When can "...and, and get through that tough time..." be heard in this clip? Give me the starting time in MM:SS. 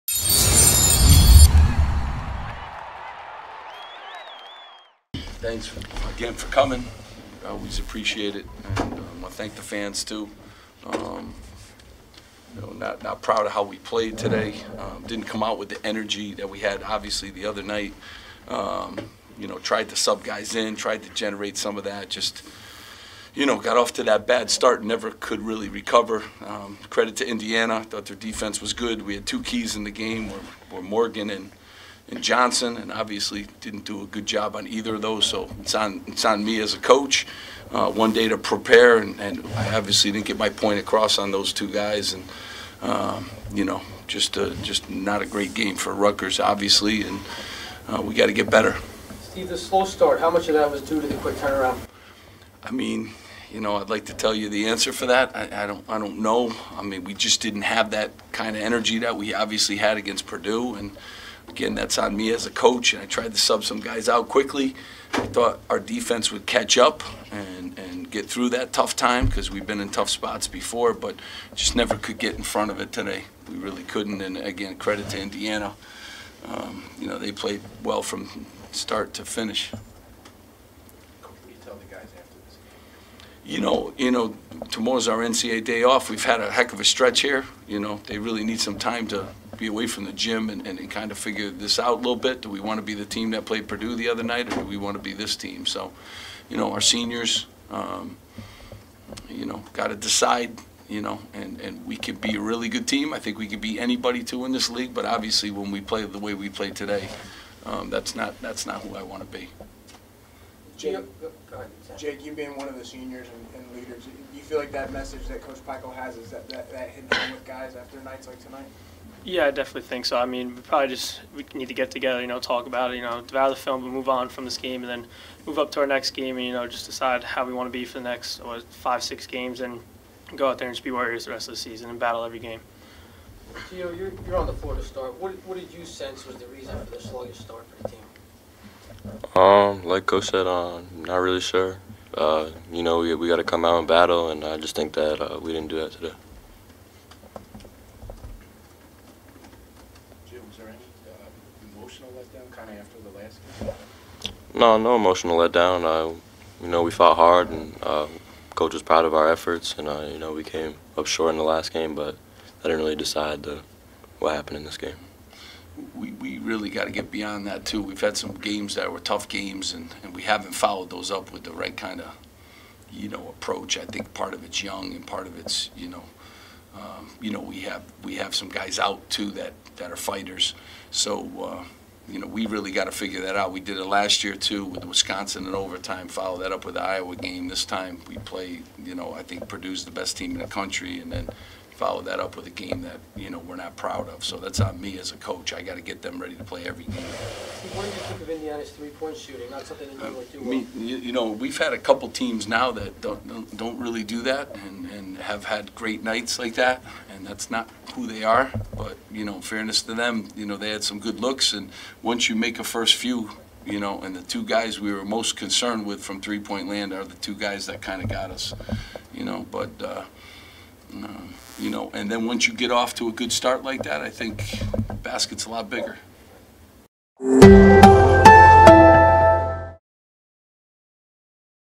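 01:07.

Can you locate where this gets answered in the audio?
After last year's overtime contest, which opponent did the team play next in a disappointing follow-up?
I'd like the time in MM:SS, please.
03:06.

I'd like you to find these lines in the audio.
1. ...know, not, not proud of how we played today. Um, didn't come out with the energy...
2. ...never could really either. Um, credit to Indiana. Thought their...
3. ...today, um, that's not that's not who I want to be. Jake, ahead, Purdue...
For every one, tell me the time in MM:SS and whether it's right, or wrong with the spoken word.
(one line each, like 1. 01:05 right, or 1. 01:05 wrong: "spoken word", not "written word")
1. 00:12 right
2. 00:24 wrong: "recover", not "either"
3. 01:46 wrong: "Jake", not "Purdue".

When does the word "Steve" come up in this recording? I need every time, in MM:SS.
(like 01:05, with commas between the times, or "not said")
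00:49.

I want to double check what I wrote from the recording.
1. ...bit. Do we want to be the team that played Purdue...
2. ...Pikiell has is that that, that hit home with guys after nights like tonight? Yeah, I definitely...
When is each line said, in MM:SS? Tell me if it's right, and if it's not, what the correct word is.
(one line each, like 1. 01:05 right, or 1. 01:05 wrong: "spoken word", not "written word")
1. 01:32 right
2. 01:55 right.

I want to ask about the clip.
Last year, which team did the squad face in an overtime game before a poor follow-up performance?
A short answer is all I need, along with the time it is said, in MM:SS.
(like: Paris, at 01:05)
Wisconsin, at 03:04.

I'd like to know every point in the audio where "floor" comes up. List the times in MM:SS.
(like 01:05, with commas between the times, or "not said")
02:14.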